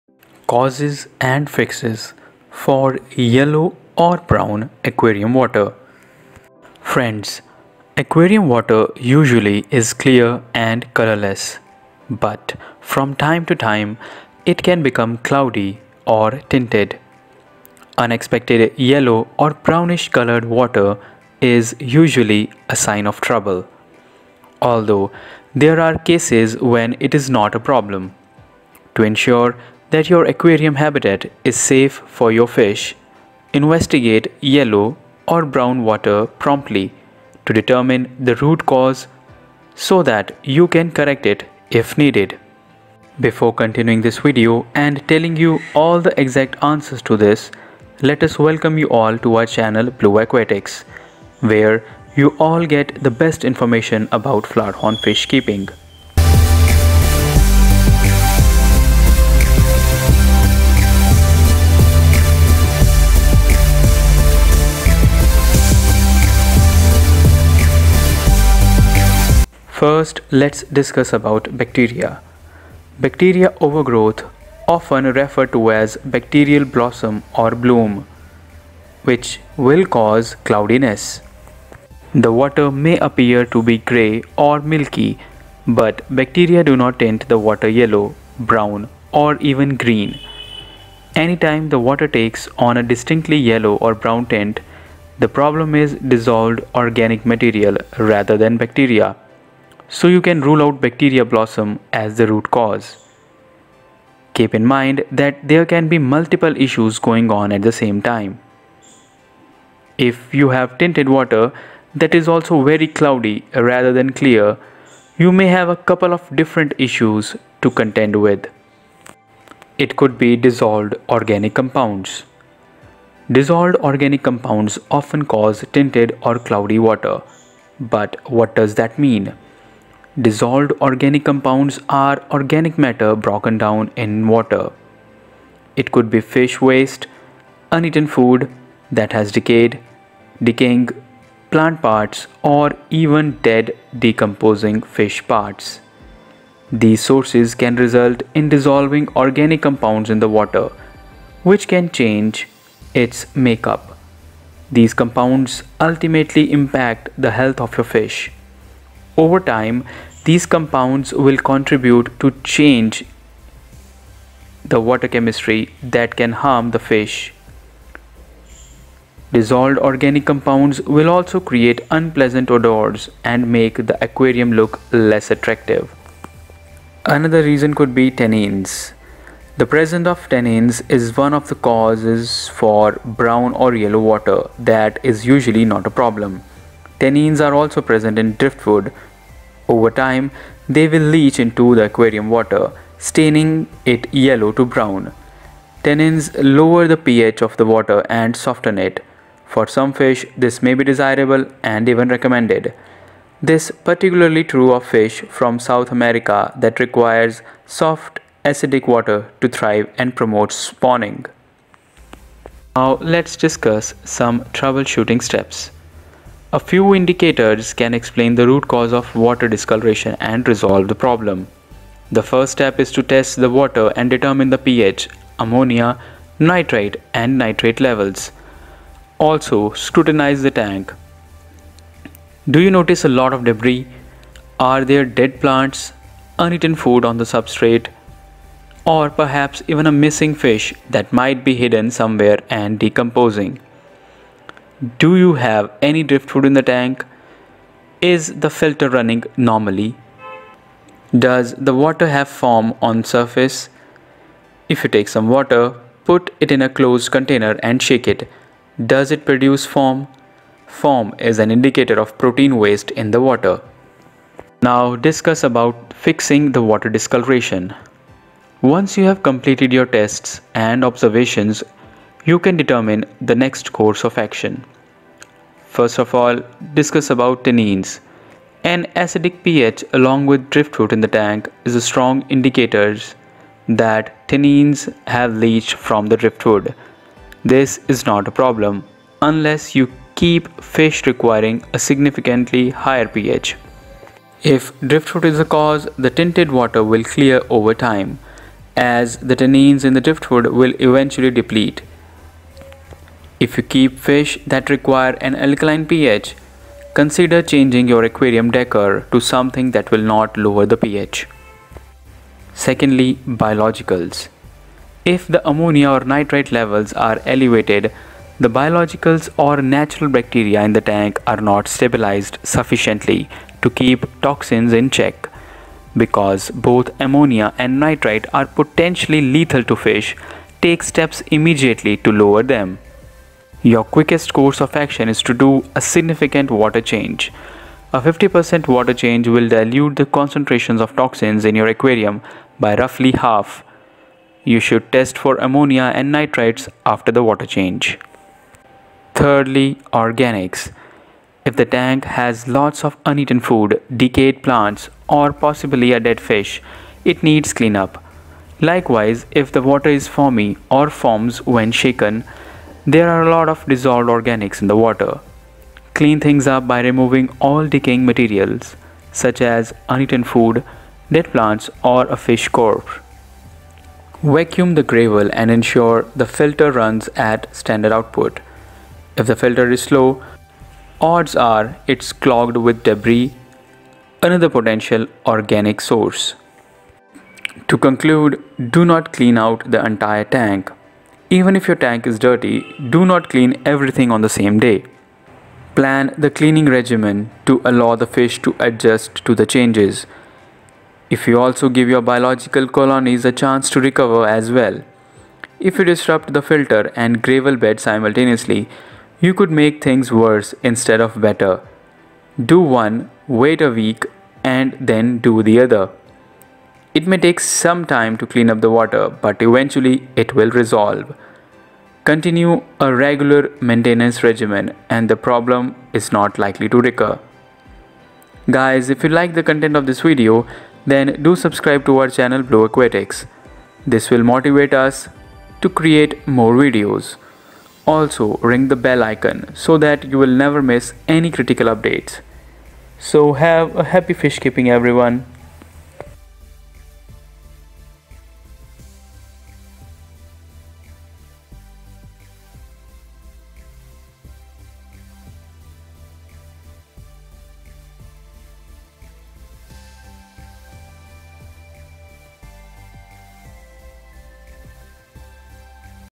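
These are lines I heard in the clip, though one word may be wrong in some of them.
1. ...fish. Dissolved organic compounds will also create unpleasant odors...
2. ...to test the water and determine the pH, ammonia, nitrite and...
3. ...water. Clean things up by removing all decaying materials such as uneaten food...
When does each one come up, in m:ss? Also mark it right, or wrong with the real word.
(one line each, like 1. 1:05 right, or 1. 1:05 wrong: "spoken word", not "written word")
1. 2:46 right
2. 3:42 right
3. 6:04 right.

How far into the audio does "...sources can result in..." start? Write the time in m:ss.
2:26.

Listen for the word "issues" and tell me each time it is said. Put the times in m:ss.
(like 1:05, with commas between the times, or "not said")
1:46, 1:56.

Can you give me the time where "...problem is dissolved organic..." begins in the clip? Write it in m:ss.
1:35.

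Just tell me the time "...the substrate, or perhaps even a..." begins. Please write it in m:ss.
3:57.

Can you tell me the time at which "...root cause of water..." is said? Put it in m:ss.
3:38.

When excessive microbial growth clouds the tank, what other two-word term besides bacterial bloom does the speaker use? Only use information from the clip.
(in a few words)
bacterial blossom.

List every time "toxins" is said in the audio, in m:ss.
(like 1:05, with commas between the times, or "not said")
5:24, 5:40.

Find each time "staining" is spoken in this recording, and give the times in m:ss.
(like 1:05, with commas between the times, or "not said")
3:12.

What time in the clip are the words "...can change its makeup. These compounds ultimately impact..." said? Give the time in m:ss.
2:31.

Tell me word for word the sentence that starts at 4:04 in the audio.
Do you have any driftwood in the tank?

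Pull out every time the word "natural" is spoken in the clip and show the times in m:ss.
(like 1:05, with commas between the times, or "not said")
5:19.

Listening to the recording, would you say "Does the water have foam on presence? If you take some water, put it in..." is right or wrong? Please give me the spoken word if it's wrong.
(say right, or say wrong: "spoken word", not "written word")
wrong: "surface", not "presence".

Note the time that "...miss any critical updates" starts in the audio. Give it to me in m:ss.
7:20.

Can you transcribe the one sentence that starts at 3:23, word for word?
This particularly true of fish from South America that requires soft acidic water to thrive and promote spawning.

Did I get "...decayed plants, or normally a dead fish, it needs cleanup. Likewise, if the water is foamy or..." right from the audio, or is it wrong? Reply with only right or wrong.
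wrong.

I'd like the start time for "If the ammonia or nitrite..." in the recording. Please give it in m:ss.
5:15.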